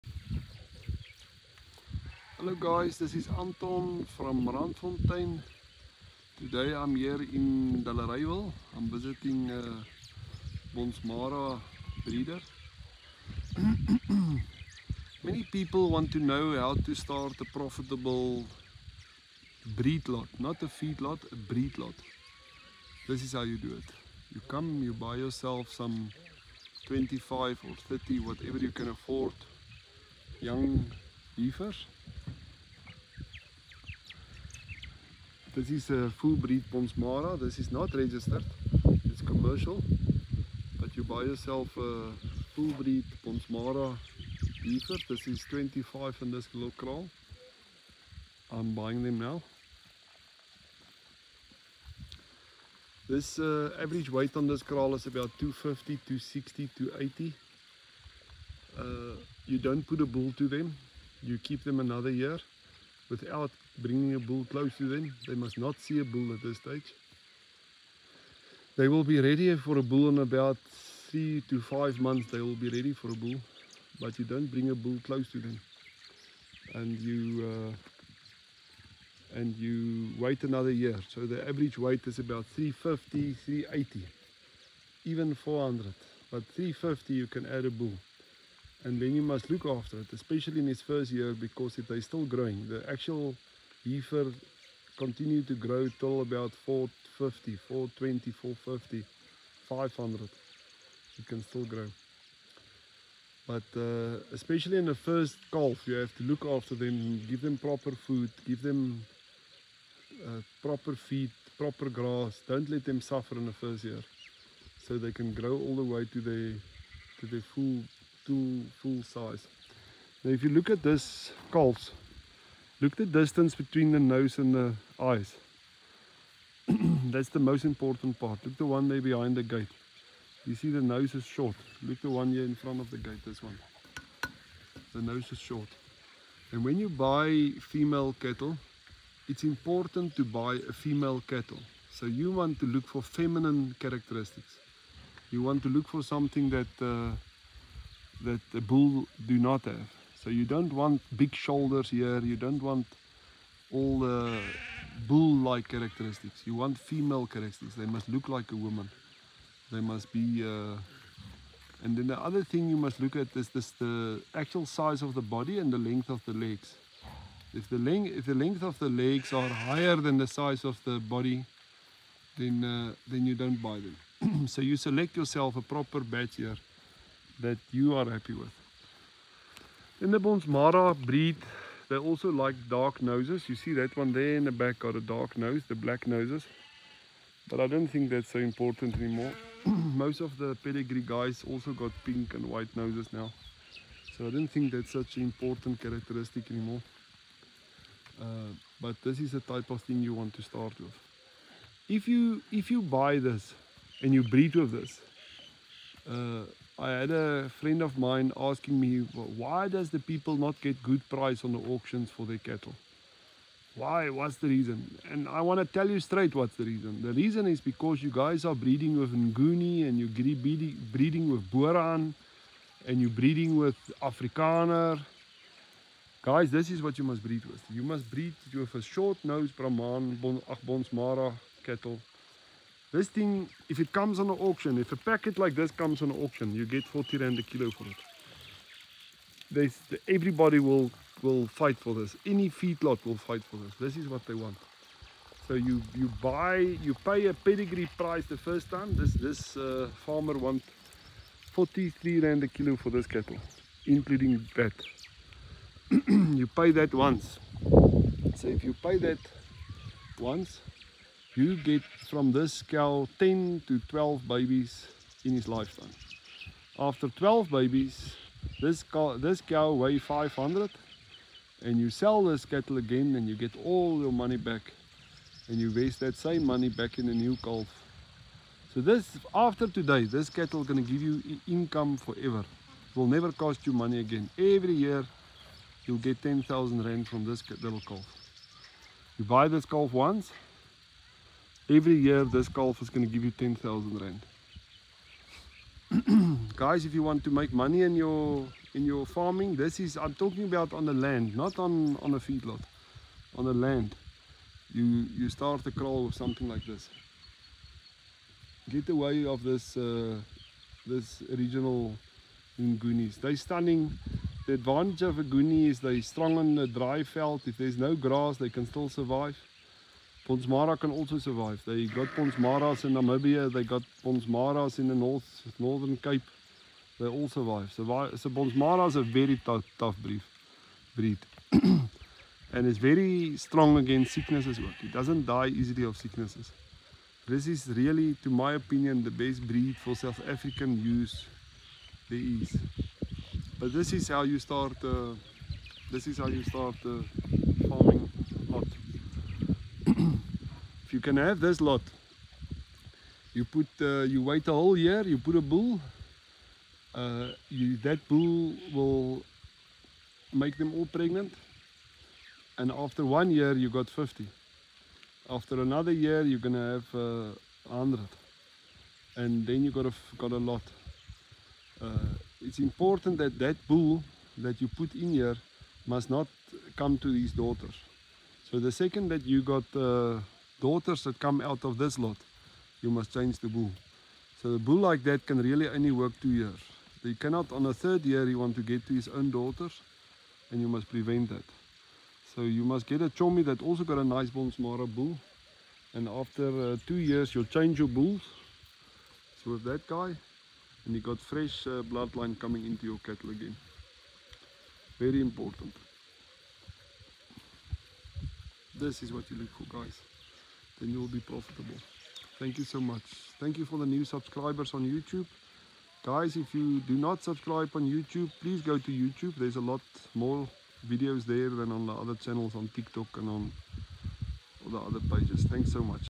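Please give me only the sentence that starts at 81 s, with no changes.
So the average weight is about 350, 380, even 400.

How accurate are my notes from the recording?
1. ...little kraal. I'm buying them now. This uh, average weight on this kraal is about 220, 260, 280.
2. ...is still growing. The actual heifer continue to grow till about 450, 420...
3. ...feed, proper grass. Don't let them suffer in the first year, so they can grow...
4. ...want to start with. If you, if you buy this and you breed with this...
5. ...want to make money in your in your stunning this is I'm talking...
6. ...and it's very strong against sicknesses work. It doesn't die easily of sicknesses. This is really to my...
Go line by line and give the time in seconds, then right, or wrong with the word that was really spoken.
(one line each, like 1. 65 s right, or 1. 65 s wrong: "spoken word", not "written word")
1. 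46 s wrong: "250", not "220"
2. 91 s right
3. 110 s right
4. 200 s right
5. 297 s wrong: "farming", not "stunning"
6. 331 s right.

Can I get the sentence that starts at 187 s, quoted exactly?
But I don't think that's so important anymore.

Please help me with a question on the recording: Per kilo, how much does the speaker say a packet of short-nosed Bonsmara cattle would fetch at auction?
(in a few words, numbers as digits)
40 rand.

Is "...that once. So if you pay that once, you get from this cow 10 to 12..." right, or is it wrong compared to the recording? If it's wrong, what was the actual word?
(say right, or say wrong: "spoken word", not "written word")
right.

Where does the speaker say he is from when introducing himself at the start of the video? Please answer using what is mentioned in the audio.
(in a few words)
Randfontein.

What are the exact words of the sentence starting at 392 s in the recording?
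So you must get a chomi that also got a nice Bonsmara bull.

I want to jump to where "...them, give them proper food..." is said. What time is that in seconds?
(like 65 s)
106 s.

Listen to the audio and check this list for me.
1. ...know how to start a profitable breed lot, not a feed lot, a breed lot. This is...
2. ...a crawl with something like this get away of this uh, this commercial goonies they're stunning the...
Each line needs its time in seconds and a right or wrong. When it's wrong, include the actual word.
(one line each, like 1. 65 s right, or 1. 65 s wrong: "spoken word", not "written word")
1. 16 s right
2. 305 s wrong: "regional", not "commercial".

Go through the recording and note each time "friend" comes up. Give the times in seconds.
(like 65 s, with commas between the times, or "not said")
207 s.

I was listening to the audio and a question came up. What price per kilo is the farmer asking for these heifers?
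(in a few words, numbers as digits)
43 rand.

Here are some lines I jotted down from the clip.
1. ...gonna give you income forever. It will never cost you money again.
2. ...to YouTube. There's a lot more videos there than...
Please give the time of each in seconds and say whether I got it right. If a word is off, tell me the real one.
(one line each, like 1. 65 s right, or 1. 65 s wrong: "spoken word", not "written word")
1. 280 s right
2. 418 s right.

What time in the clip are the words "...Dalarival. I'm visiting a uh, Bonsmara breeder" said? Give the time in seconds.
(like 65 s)
7 s.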